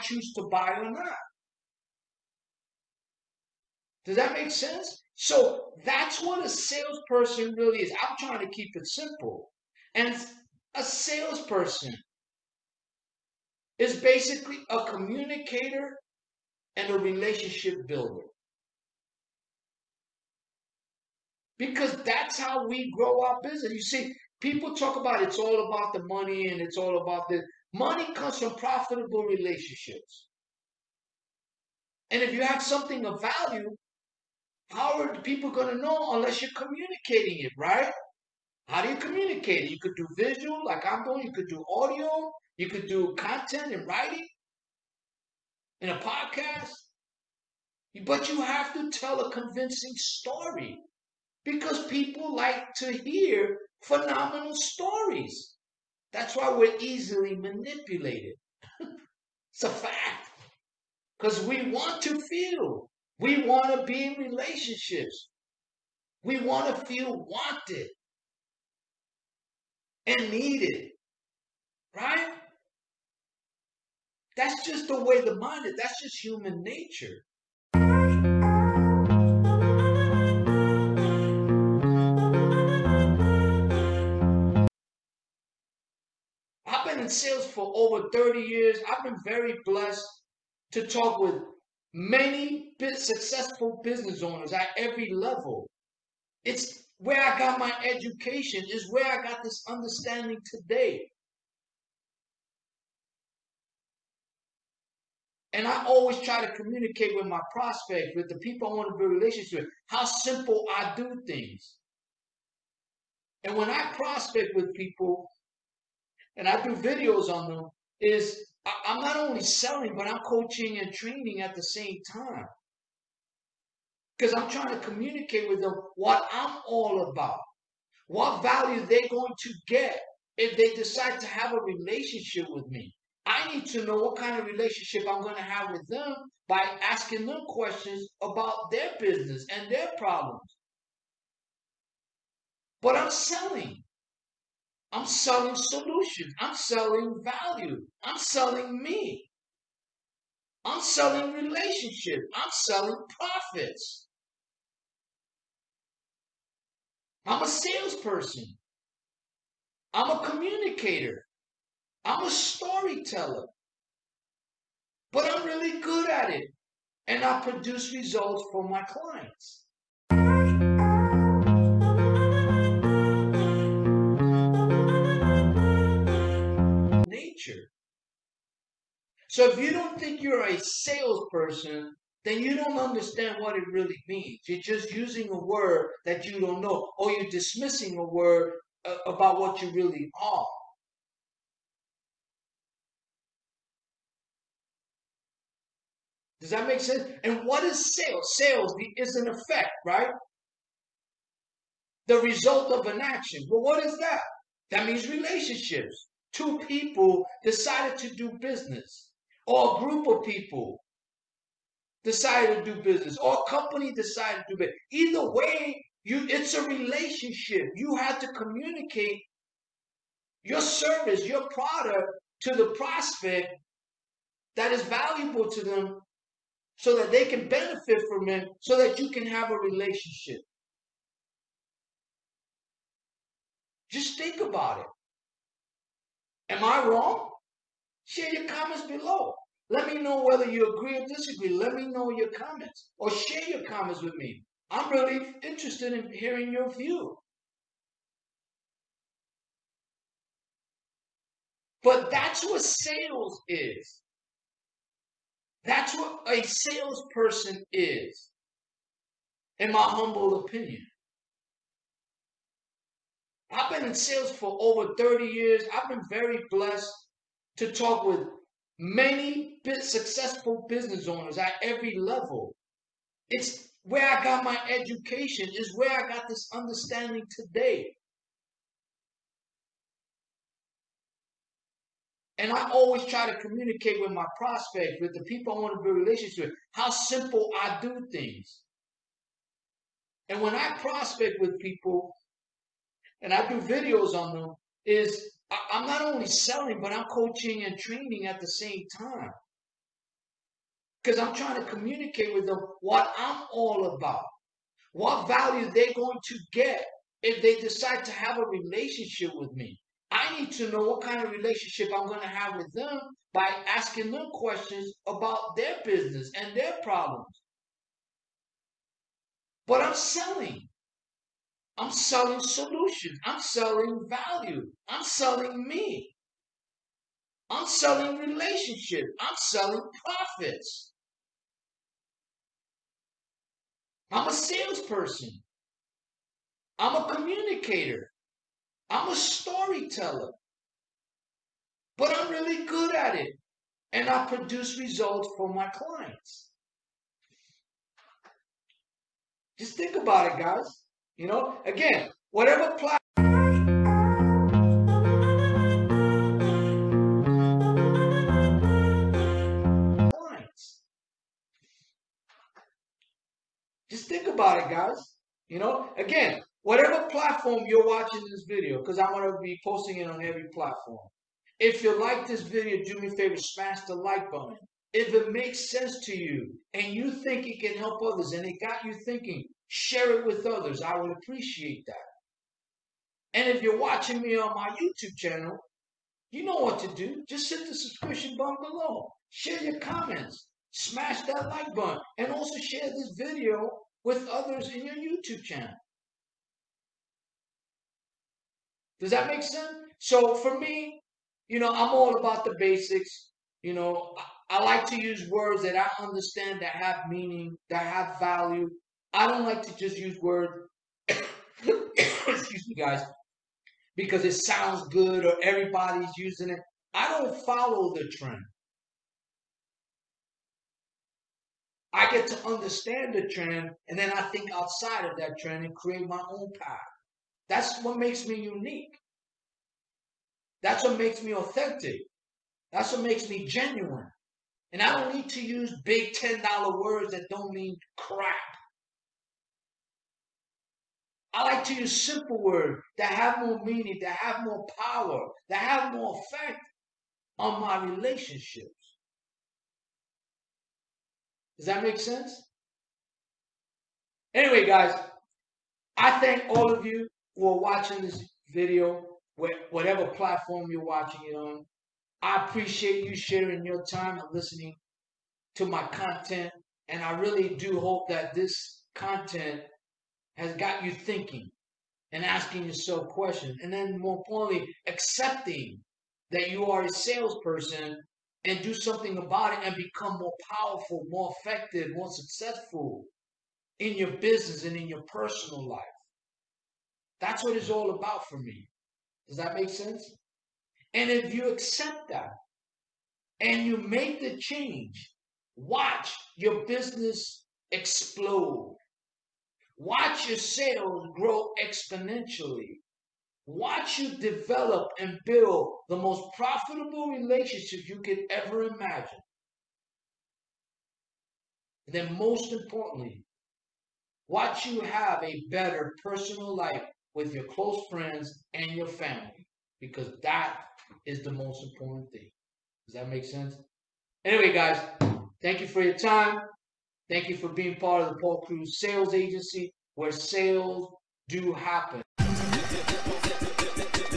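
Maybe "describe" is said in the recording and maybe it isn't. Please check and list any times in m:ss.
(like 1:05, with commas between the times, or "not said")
not said.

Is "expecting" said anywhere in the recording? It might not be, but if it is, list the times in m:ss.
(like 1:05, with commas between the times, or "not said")
not said.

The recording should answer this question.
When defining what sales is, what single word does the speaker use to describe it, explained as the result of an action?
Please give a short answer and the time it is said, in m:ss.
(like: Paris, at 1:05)
An effect, at 3:19.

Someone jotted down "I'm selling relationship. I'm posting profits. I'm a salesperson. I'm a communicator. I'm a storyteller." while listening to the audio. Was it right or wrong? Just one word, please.
wrong.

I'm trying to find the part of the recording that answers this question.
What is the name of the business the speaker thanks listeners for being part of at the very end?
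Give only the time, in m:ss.
8:48.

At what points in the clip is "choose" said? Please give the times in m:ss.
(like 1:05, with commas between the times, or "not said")
0:00.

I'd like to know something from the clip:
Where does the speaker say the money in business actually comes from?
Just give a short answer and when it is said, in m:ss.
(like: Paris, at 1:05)
Profitable relationships, at 0:28.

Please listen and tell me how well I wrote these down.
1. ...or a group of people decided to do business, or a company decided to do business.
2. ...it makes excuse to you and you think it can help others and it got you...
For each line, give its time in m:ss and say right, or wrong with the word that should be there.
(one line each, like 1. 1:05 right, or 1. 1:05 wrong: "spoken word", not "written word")
1. 3:29 right
2. 6:15 wrong: "sense", not "excuse".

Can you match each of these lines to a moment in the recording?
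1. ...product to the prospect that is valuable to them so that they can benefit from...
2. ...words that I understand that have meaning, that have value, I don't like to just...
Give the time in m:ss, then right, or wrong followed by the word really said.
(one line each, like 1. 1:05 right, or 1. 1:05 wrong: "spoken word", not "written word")
1. 3:41 right
2. 6:45 right.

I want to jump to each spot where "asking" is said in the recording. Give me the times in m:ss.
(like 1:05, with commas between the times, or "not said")
2:16, 5:13, 7:52.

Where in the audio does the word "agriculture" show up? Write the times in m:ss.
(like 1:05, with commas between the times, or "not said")
not said.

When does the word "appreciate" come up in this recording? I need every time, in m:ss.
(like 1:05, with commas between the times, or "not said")
6:21, 7:42.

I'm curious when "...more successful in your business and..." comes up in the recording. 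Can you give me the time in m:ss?
8:01.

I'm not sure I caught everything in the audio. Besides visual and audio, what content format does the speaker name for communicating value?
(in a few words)
Podcast.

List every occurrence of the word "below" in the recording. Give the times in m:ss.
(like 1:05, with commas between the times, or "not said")
3:58, 6:28.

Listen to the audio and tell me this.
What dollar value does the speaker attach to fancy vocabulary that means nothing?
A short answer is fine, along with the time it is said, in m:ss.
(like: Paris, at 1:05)
$10, at 7:16.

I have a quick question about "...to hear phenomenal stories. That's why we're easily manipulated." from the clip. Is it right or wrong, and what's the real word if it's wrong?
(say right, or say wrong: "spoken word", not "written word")
right.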